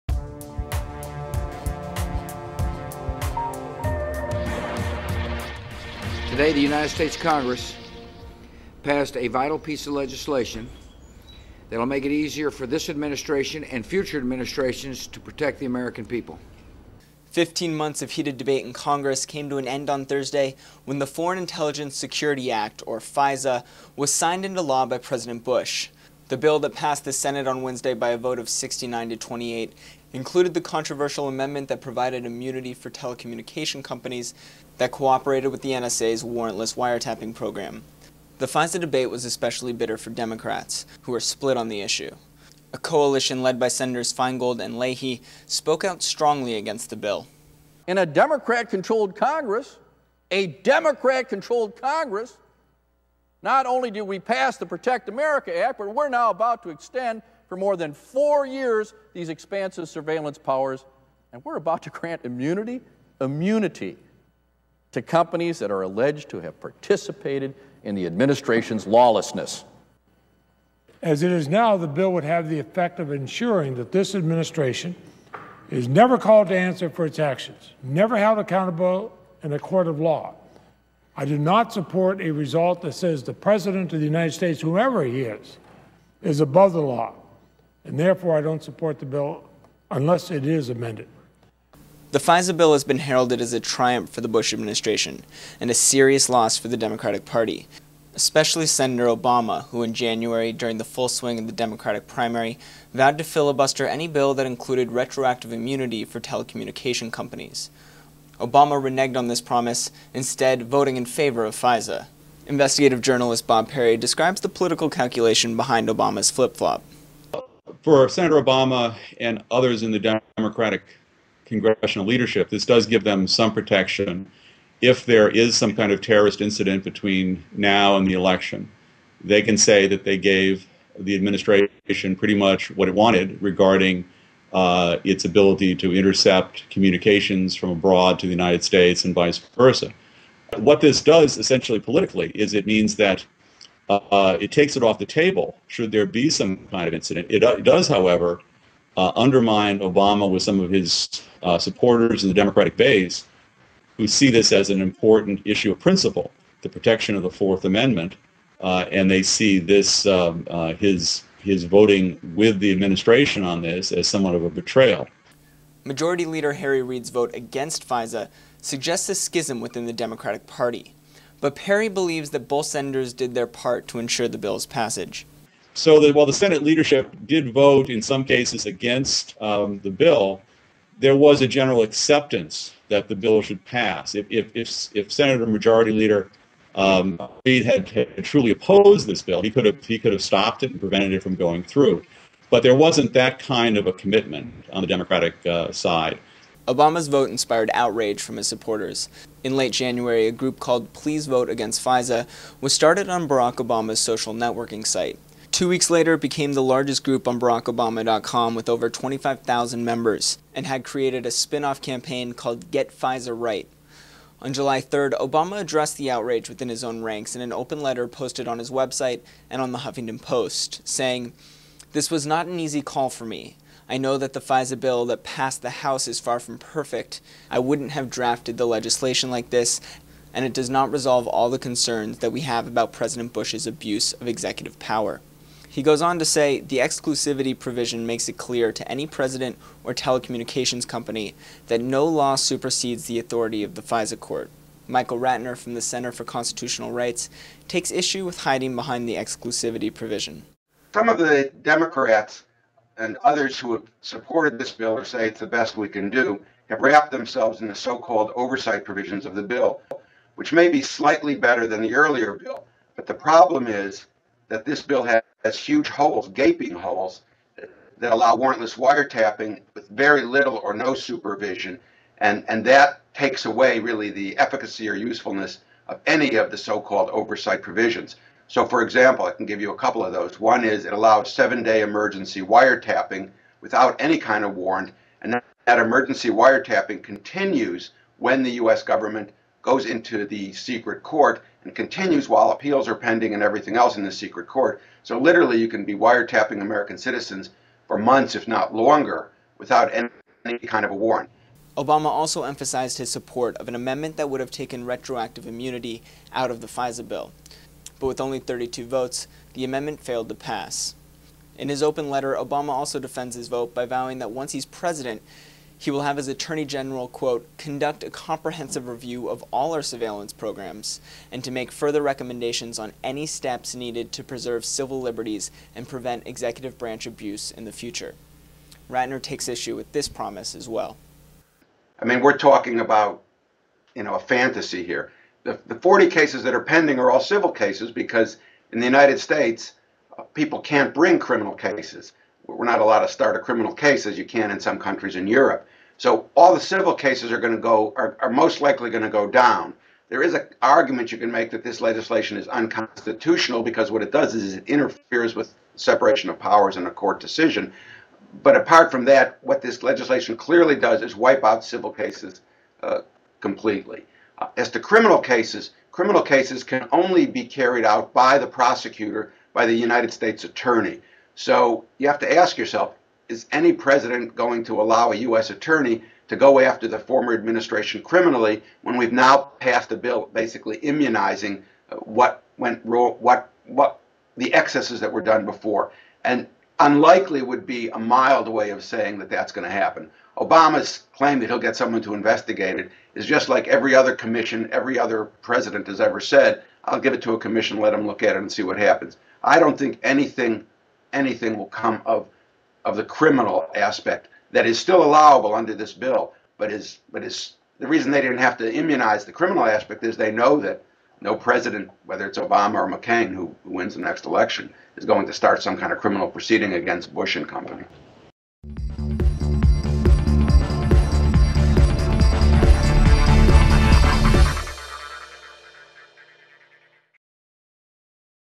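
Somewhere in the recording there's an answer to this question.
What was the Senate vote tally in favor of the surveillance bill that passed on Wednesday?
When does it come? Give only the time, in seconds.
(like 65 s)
28 s.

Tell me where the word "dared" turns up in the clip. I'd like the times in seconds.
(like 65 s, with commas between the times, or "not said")
not said.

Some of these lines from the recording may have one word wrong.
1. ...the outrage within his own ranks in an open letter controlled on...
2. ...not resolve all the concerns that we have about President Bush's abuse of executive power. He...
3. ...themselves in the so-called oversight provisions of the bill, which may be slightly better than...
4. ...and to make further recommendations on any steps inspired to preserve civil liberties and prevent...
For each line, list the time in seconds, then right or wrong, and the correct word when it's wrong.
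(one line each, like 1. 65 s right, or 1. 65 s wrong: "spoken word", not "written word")
1. 215 s wrong: "posted", not "controlled"
2. 230 s right
3. 257 s right
4. 321 s wrong: "needed", not "inspired".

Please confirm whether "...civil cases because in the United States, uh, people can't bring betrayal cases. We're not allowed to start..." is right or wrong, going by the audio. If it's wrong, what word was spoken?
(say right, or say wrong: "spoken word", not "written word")
wrong: "criminal", not "betrayal".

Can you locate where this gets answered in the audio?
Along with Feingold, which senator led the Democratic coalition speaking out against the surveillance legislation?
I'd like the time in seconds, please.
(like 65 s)
44 s.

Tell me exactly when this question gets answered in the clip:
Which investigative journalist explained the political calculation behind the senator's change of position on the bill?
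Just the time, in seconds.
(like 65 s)
113 s.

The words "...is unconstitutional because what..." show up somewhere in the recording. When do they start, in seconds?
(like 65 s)
352 s.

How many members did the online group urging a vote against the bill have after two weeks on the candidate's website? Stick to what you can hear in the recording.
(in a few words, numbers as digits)
over 25,000.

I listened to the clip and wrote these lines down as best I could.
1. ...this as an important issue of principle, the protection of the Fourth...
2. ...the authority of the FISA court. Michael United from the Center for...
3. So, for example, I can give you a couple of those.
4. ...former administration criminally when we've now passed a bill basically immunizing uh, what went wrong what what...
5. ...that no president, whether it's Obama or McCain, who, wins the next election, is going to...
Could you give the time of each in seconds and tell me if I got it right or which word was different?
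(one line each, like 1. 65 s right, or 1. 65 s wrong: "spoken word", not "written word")
1. 154 s right
2. 243 s wrong: "Ratner", not "United"
3. 278 s right
4. 376 s right
5. 410 s right.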